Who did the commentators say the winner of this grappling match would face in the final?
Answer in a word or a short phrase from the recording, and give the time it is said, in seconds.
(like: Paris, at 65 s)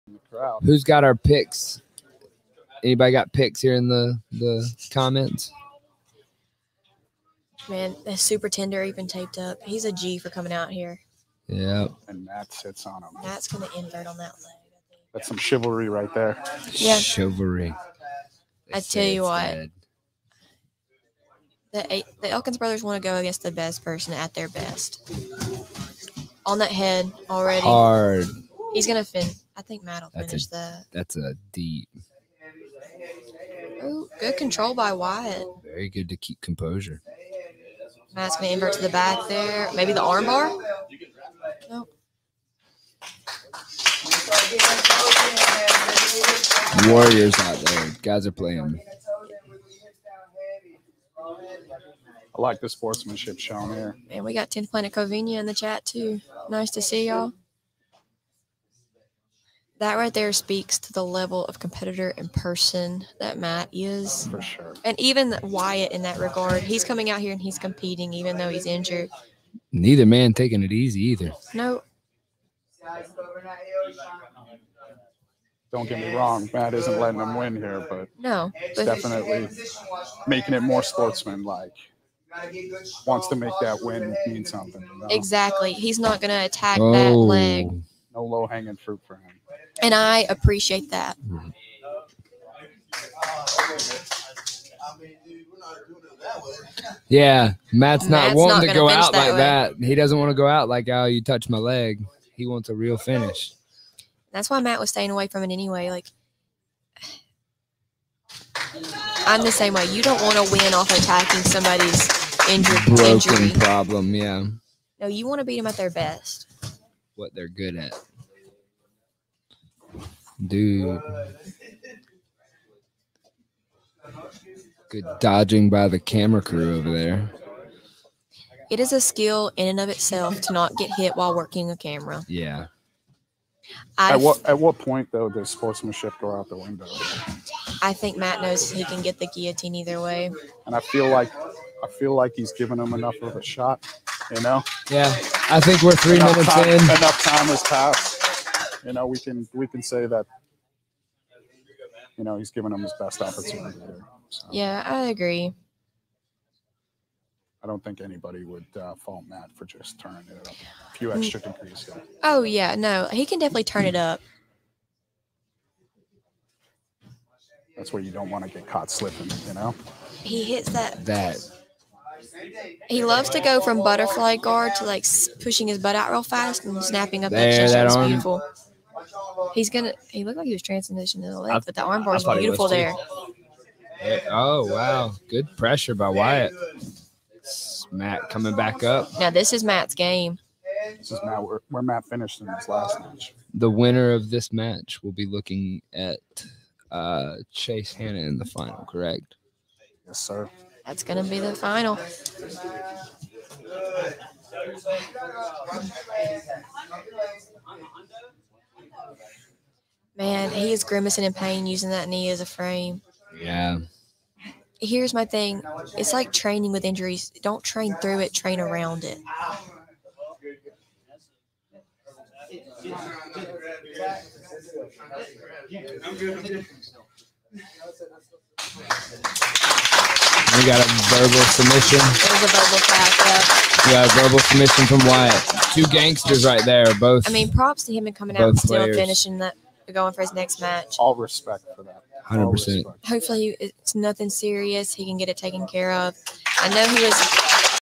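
Chase Hanna, at 197 s.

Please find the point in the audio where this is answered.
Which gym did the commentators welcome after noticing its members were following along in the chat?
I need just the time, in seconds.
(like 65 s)
54 s.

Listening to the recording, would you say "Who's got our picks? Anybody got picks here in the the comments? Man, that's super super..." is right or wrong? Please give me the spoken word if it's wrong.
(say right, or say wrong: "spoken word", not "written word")
wrong: "tender", not "super".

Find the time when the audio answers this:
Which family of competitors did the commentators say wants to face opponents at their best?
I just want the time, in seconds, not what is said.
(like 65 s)
22 s.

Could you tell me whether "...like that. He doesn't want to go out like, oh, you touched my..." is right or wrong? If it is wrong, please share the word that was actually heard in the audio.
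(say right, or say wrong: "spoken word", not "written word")
right.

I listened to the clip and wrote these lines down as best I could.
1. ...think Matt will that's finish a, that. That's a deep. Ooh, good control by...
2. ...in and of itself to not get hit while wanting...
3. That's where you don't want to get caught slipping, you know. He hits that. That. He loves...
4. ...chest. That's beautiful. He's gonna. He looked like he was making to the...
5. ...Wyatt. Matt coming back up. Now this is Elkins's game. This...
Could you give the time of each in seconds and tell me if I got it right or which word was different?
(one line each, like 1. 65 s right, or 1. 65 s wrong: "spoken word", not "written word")
1. 29 s right
2. 129 s wrong: "working", not "wanting"
3. 167 s right
4. 177 s wrong: "transitioning", not "making"
5. 186 s wrong: "Matt", not "Elkins".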